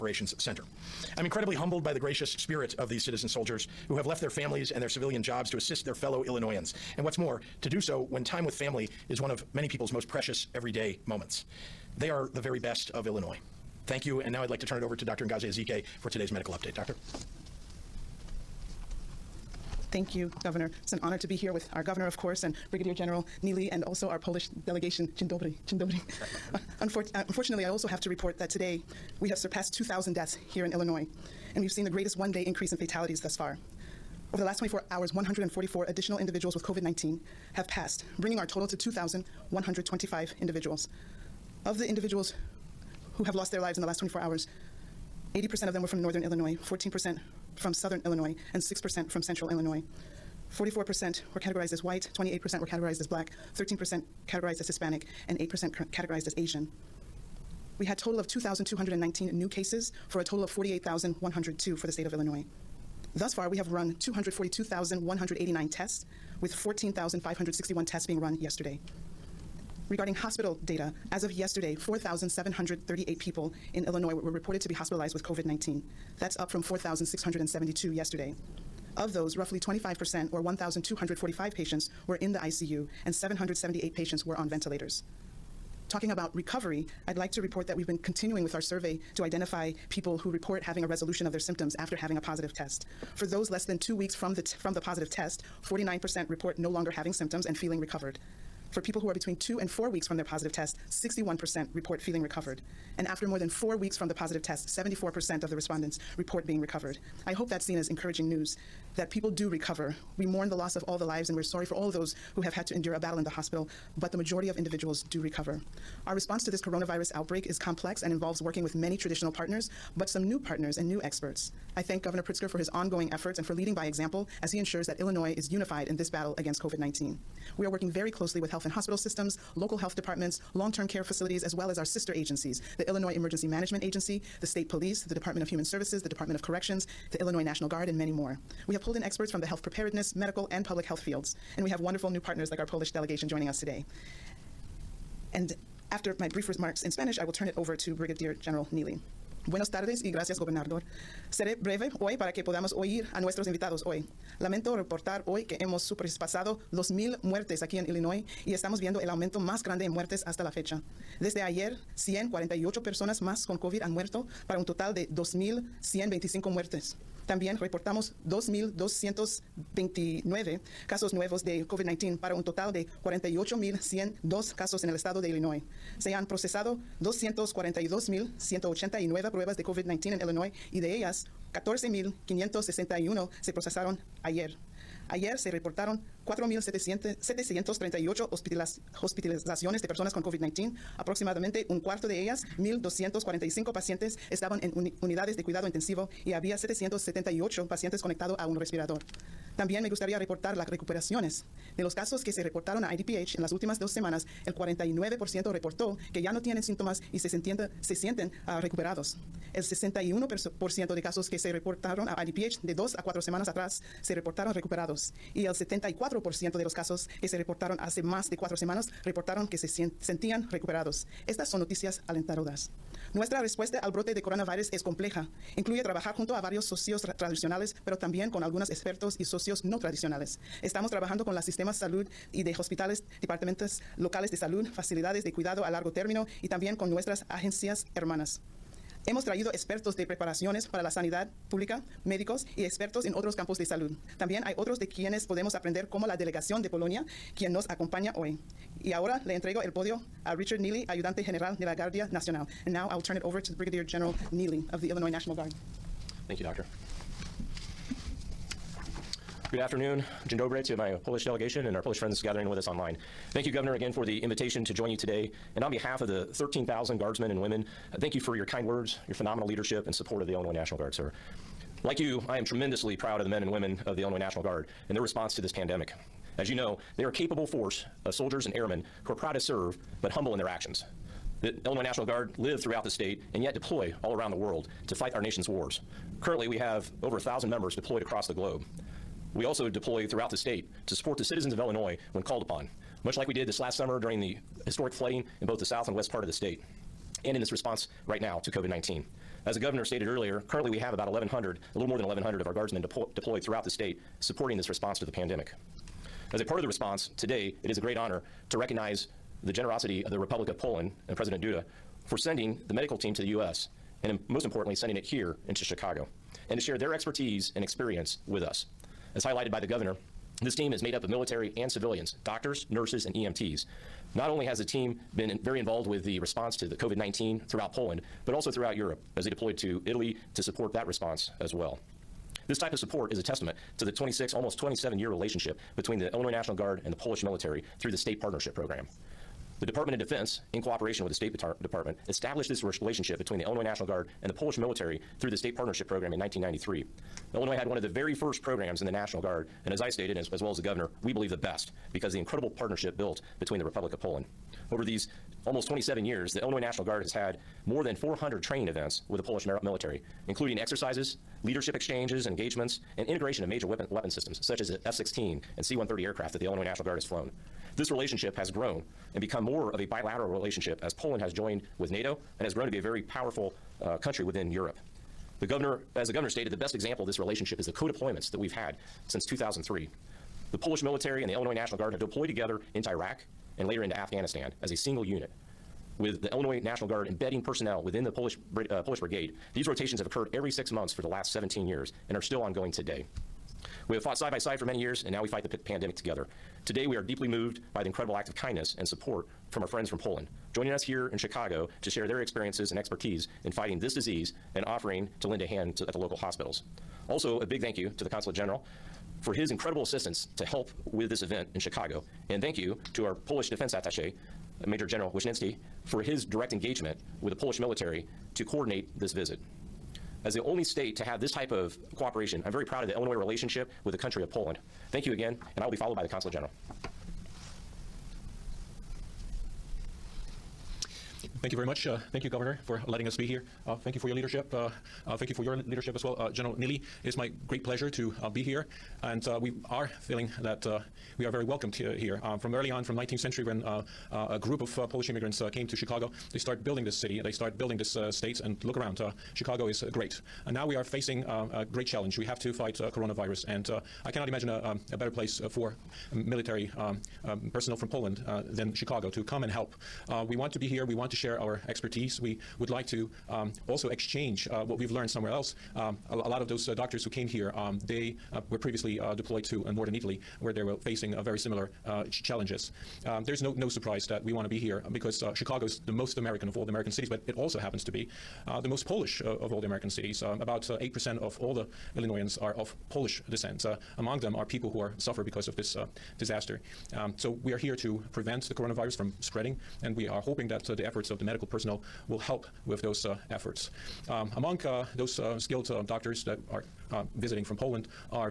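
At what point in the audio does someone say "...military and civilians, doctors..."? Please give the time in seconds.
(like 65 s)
321 s.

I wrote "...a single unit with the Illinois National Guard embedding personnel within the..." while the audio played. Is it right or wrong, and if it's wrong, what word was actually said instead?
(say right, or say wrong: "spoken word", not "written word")
right.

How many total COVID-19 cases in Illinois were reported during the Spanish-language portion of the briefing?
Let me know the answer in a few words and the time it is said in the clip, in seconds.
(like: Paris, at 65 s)
48,102, at 173 s.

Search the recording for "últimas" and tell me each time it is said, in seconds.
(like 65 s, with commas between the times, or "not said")
203 s.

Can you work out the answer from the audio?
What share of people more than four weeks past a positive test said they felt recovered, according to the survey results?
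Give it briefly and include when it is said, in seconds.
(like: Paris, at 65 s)
74%, at 104 s.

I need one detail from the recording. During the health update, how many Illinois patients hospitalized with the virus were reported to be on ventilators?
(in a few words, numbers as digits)
778.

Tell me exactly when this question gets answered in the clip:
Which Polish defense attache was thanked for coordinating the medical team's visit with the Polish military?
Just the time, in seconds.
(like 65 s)
414 s.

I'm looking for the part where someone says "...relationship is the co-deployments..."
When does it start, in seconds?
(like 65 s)
377 s.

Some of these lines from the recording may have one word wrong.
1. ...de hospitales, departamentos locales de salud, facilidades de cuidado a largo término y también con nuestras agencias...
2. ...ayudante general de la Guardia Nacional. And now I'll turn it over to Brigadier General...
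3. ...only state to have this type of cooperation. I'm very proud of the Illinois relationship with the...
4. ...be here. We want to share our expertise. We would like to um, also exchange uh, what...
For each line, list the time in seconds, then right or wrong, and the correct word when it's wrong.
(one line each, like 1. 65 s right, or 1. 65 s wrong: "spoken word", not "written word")
1. 232 s right
2. 250 s right
3. 420 s right
4. 460 s right.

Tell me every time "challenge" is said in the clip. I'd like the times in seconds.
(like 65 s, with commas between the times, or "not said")
451 s, 472 s.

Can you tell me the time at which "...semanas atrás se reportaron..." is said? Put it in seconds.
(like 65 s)
213 s.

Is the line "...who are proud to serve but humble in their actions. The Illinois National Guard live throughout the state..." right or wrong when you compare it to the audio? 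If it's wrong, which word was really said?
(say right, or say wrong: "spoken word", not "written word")
right.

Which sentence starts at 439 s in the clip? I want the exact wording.
And uh, we are feeling that uh, we are very welcomed here.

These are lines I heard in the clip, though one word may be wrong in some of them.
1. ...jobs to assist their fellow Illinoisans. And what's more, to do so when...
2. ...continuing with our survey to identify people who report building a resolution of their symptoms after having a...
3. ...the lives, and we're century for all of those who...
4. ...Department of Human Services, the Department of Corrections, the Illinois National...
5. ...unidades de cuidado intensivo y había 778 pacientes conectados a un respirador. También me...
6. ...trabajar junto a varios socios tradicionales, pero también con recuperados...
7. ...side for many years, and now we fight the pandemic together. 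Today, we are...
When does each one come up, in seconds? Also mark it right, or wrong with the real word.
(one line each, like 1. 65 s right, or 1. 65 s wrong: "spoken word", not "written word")
1. 5 s right
2. 88 s wrong: "having", not "building"
3. 110 s wrong: "sorry", not "century"
4. 135 s right
5. 195 s right
6. 225 s wrong: "algunos", not "recuperados"
7. 394 s right.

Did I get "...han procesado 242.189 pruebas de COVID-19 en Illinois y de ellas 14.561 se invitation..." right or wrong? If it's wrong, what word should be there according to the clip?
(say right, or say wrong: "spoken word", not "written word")
wrong: "procesaron", not "invitation".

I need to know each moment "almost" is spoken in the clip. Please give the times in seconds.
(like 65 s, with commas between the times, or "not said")
334 s, 355 s.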